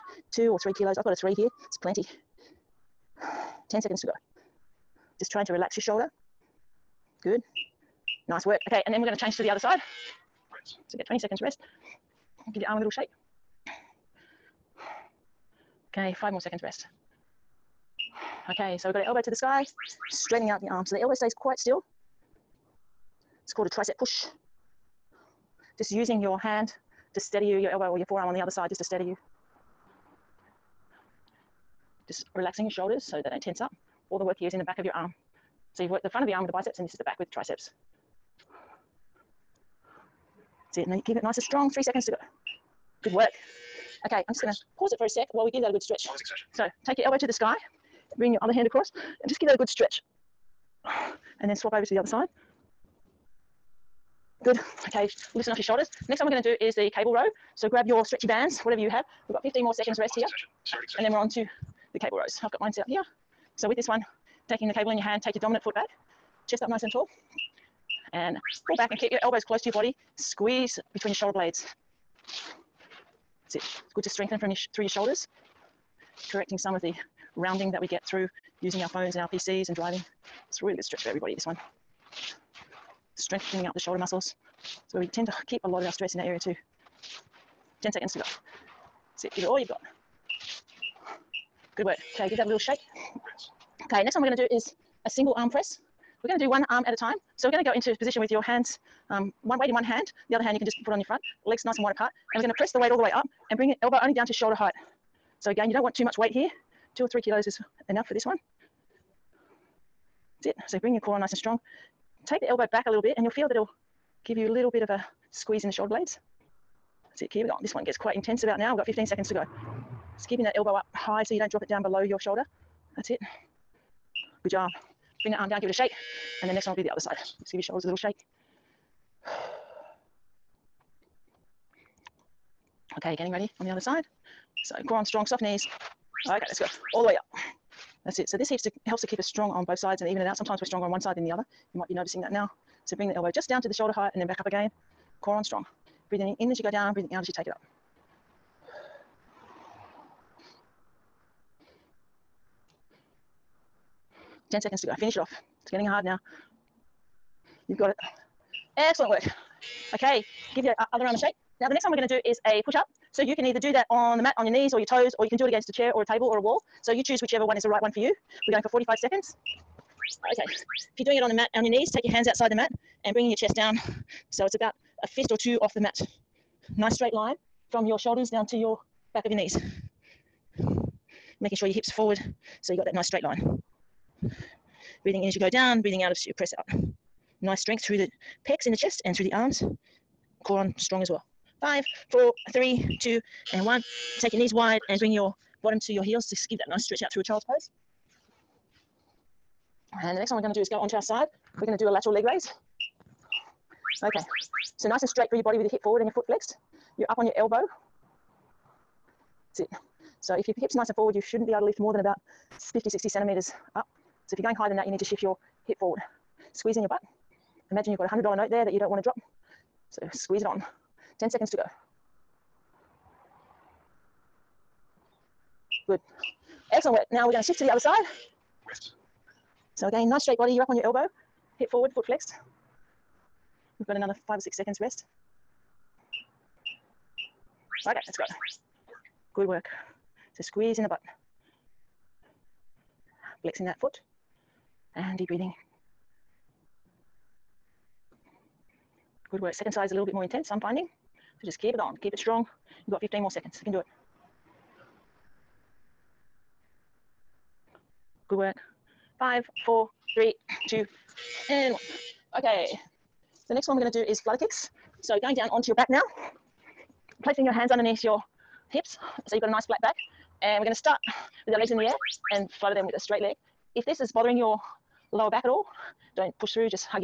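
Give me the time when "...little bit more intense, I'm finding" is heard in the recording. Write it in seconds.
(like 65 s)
249 s.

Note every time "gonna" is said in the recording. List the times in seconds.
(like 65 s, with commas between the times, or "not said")
44 s, 161 s.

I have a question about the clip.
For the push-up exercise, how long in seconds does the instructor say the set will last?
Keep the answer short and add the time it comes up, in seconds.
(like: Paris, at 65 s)
45 seconds, at 168 s.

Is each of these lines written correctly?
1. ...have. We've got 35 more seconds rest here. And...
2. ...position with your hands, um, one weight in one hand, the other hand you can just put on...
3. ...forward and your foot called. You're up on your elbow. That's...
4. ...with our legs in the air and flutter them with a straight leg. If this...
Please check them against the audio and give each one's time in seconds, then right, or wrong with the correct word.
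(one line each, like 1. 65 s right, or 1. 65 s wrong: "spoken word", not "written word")
1. 58 s wrong: "15", not "35"
2. 97 s right
3. 205 s wrong: "flexed", not "called"
4. 271 s right.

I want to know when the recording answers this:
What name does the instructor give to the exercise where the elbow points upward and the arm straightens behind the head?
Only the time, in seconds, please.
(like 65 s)
23 s.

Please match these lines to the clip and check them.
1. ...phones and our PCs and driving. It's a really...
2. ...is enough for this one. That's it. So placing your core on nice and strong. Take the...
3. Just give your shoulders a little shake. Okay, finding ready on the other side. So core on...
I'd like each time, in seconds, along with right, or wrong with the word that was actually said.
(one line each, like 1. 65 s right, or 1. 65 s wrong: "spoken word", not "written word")
1. 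78 s right
2. 107 s wrong: "bring", not "placing"
3. 127 s wrong: "getting", not "finding".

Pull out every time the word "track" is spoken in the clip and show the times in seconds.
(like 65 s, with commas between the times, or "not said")
not said.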